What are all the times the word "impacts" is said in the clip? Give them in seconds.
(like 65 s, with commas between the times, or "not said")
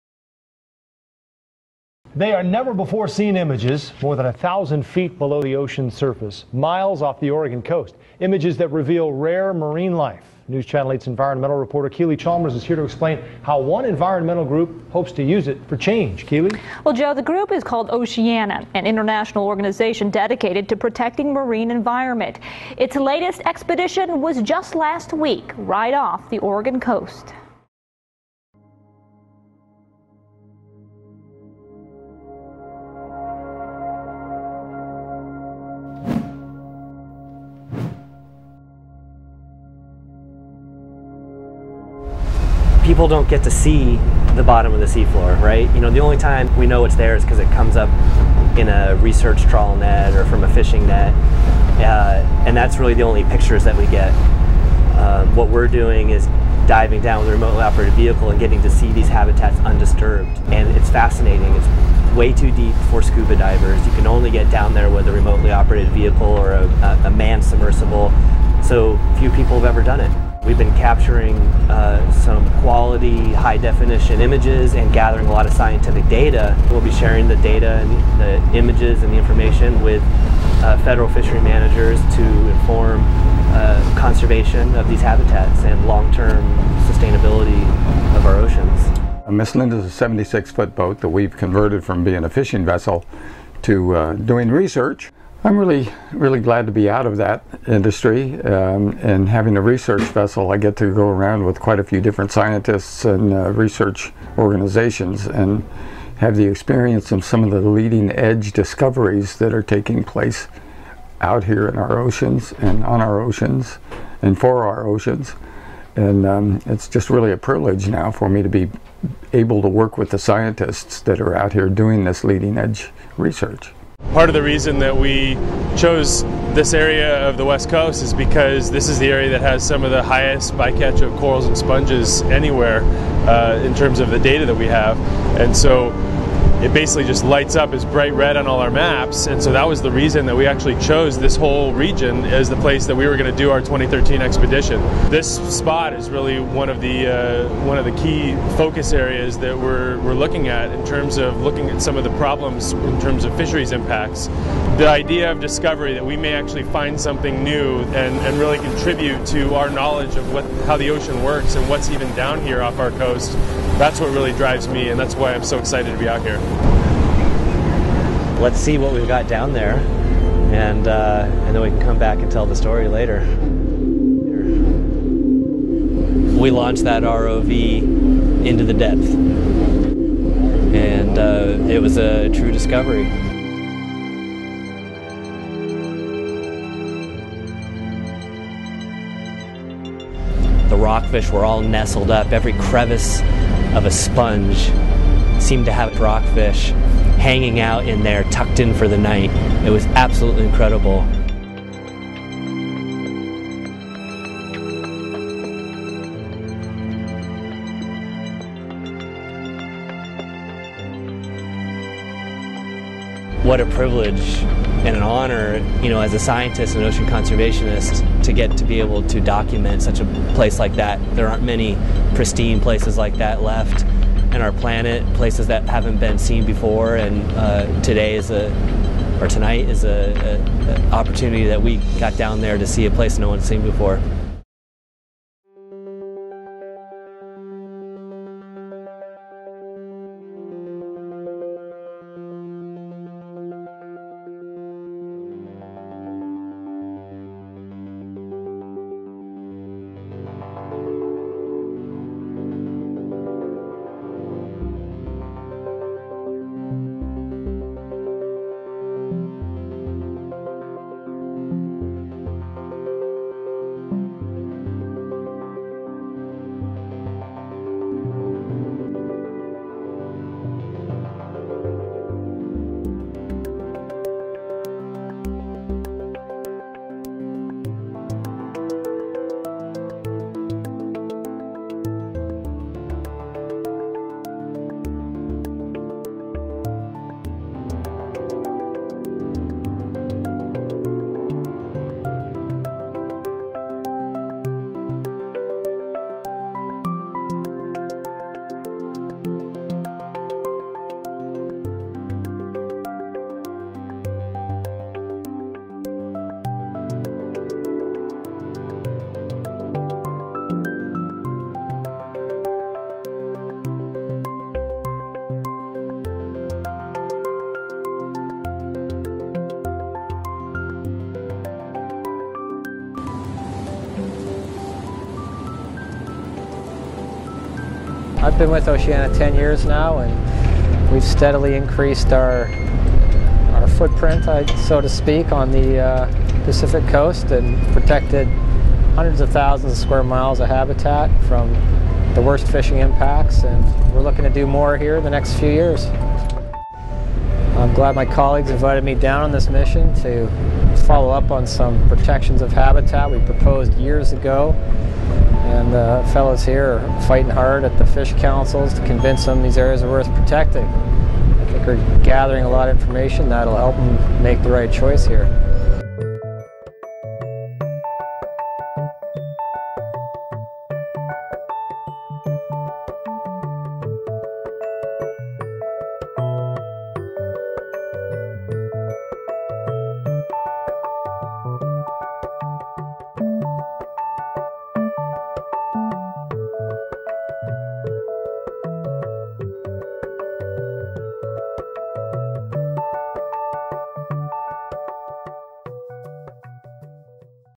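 153 s, 342 s.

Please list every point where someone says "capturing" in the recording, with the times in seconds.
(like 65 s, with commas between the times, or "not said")
70 s.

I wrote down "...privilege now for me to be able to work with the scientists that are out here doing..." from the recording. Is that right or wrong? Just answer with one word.
right.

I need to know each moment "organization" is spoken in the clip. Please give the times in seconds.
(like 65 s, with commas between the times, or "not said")
19 s, 104 s.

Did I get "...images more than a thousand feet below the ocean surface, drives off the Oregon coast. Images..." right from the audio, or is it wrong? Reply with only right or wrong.
wrong.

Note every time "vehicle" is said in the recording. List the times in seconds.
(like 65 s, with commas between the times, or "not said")
57 s, 65 s.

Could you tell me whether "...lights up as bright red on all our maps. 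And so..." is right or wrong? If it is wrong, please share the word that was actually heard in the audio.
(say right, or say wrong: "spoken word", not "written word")
right.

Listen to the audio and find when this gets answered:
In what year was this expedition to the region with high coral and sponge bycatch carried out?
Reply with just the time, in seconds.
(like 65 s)
143 s.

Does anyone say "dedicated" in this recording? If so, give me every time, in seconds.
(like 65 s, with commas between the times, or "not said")
20 s.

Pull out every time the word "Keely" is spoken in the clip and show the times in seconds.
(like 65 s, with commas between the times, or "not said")
11 s, 16 s.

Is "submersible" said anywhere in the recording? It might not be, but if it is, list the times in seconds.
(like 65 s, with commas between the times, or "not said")
67 s.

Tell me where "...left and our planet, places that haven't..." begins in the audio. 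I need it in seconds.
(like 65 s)
223 s.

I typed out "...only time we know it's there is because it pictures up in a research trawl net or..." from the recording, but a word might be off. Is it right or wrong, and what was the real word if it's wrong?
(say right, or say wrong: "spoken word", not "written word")
wrong: "comes", not "pictures".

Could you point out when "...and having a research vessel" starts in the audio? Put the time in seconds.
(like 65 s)
99 s.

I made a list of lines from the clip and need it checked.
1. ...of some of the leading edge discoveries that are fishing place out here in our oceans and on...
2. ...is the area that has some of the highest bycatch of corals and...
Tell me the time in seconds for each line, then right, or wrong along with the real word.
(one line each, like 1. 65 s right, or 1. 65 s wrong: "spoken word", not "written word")
1. 107 s wrong: "taking", not "fishing"
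2. 128 s right.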